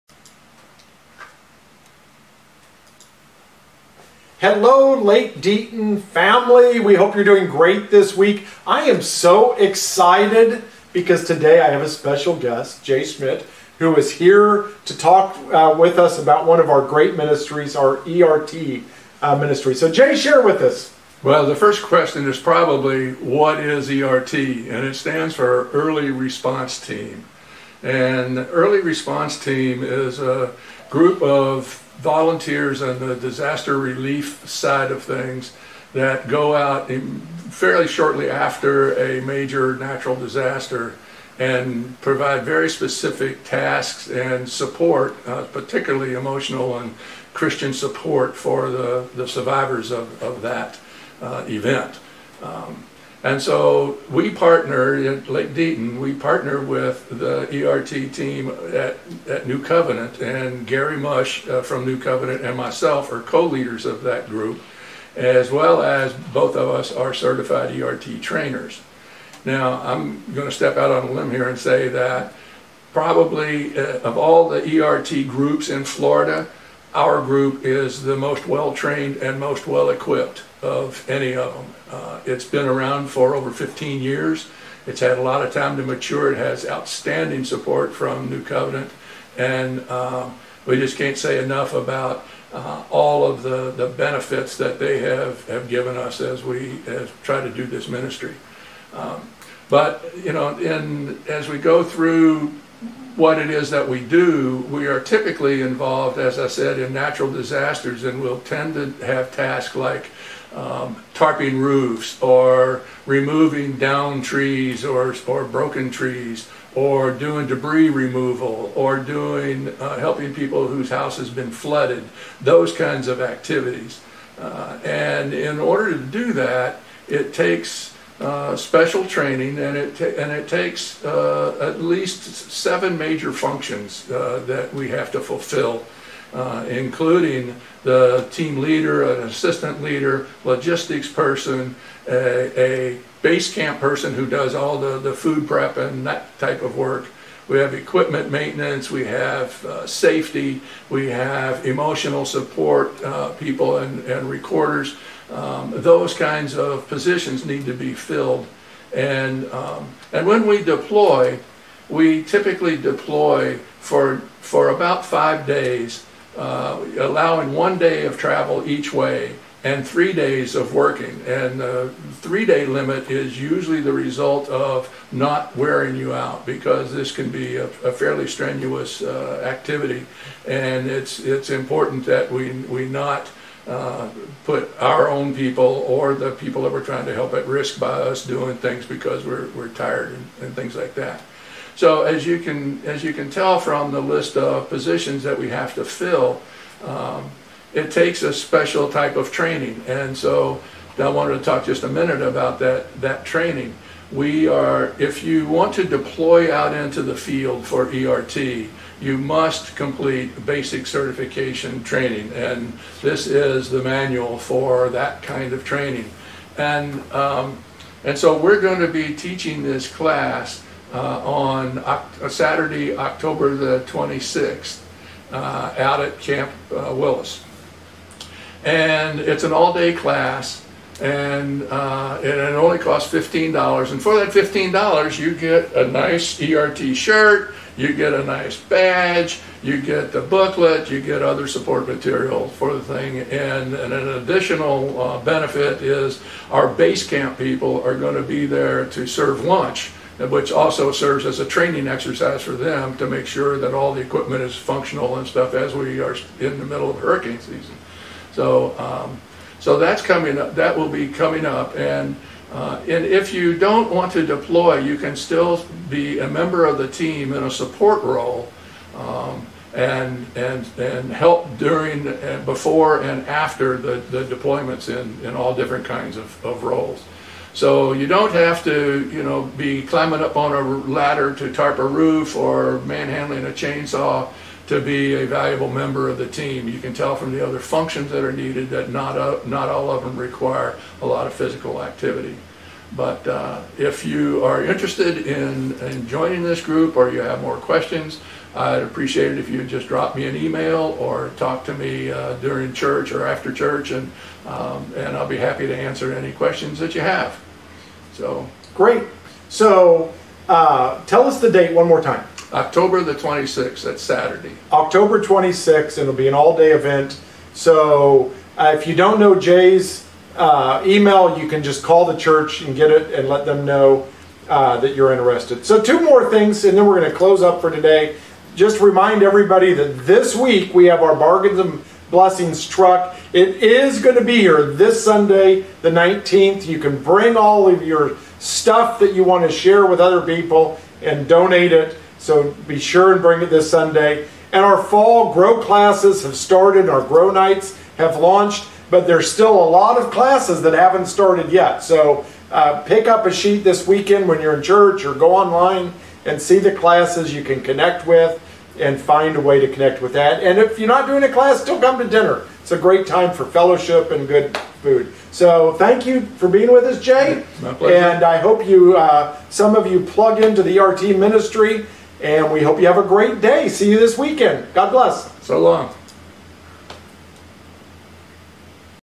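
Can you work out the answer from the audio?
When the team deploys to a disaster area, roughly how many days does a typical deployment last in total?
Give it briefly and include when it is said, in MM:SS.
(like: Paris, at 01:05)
5 days, at 02:45.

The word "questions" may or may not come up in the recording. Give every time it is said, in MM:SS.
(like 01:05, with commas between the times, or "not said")
00:21, 04:57, 05:06.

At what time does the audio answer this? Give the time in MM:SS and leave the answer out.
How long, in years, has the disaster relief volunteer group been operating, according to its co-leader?
01:23.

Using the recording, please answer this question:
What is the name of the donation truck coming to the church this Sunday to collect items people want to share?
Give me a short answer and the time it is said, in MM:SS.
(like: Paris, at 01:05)
Bargains and Blessings, at 05:31.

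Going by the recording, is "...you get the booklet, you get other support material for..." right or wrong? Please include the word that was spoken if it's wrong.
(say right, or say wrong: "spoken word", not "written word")
right.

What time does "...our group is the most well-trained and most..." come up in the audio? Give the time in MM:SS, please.
01:16.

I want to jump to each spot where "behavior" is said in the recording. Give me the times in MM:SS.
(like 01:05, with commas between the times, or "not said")
not said.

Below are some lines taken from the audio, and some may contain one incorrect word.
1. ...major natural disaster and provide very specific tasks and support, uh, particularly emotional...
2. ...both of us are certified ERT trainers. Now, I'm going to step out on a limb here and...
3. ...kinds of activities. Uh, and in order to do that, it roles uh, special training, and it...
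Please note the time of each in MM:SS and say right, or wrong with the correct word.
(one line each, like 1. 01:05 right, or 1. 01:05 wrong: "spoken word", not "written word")
1. 00:39 right
2. 01:06 right
3. 02:02 wrong: "takes", not "roles".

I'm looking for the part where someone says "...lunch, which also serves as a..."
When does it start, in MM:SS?
04:09.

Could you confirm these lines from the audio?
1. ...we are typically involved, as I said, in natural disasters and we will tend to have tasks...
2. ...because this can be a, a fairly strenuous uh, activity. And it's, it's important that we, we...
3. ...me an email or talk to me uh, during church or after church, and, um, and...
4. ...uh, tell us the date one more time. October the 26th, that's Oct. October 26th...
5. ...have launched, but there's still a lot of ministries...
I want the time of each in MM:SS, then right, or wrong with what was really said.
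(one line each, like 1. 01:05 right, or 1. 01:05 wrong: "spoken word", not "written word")
1. 01:44 right
2. 02:56 right
3. 05:00 right
4. 05:10 wrong: "Saturday", not "Oct"
5. 05:47 wrong: "classes", not "ministries".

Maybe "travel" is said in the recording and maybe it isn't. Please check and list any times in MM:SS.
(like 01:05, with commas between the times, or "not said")
02:48.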